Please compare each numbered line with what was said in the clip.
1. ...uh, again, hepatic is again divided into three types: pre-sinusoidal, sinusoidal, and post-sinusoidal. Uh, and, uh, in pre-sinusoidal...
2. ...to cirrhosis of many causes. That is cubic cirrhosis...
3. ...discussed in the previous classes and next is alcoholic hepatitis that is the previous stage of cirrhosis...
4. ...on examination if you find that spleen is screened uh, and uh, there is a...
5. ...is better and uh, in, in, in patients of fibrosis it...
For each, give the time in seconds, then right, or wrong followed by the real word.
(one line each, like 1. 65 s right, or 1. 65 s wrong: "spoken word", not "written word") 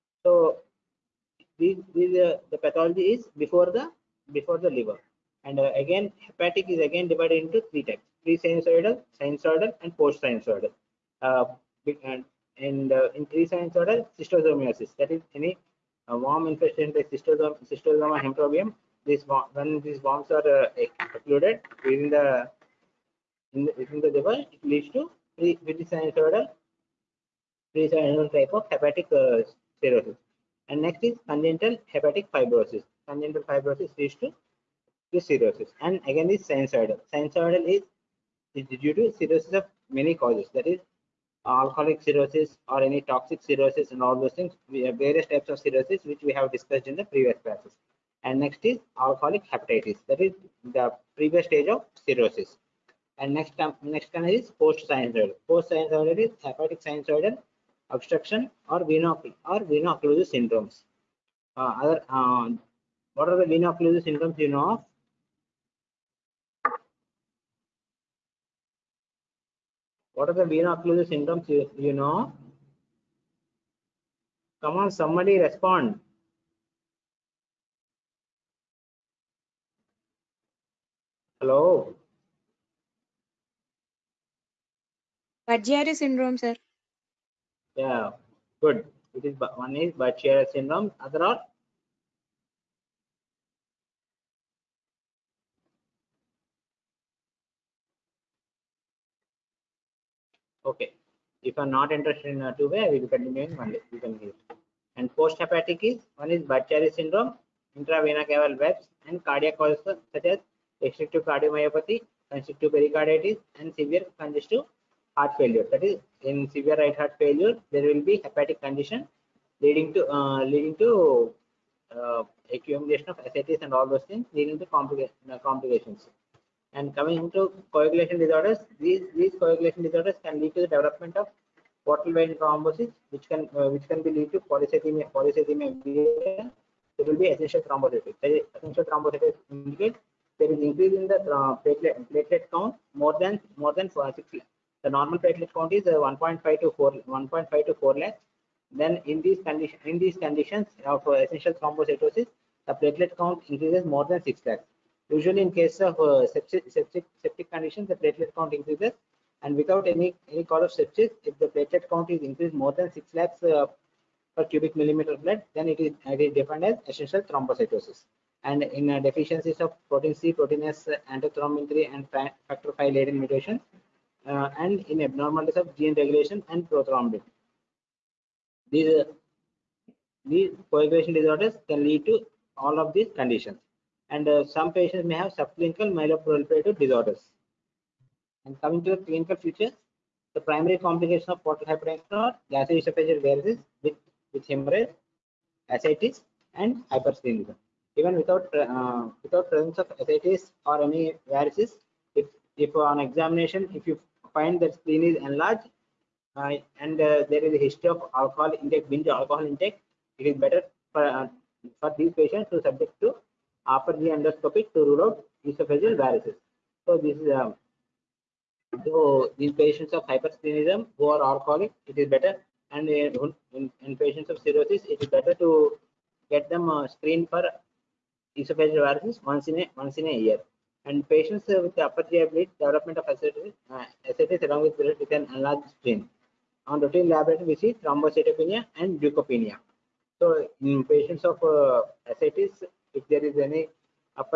1. 5 s right
2. 38 s wrong: "alcoholic", not "cubic"
3. 46 s right
4. 202 s wrong: "enlarged", not "screened"
5. 222 s wrong: "cirrhosis", not "fibrosis".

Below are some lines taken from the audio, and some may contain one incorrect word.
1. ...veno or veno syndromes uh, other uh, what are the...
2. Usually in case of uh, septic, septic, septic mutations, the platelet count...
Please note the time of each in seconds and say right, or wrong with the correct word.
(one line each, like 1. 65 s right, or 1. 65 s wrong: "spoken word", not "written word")
1. 58 s right
2. 155 s wrong: "conditions", not "mutations".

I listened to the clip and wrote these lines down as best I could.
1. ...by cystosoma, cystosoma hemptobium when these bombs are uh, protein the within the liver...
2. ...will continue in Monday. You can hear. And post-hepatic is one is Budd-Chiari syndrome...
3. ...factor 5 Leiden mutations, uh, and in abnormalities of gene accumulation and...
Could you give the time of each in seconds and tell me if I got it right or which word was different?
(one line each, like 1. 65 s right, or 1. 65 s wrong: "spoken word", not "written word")
1. 16 s wrong: "within", not "protein"
2. 102 s right
3. 172 s wrong: "regulation", not "accumulation".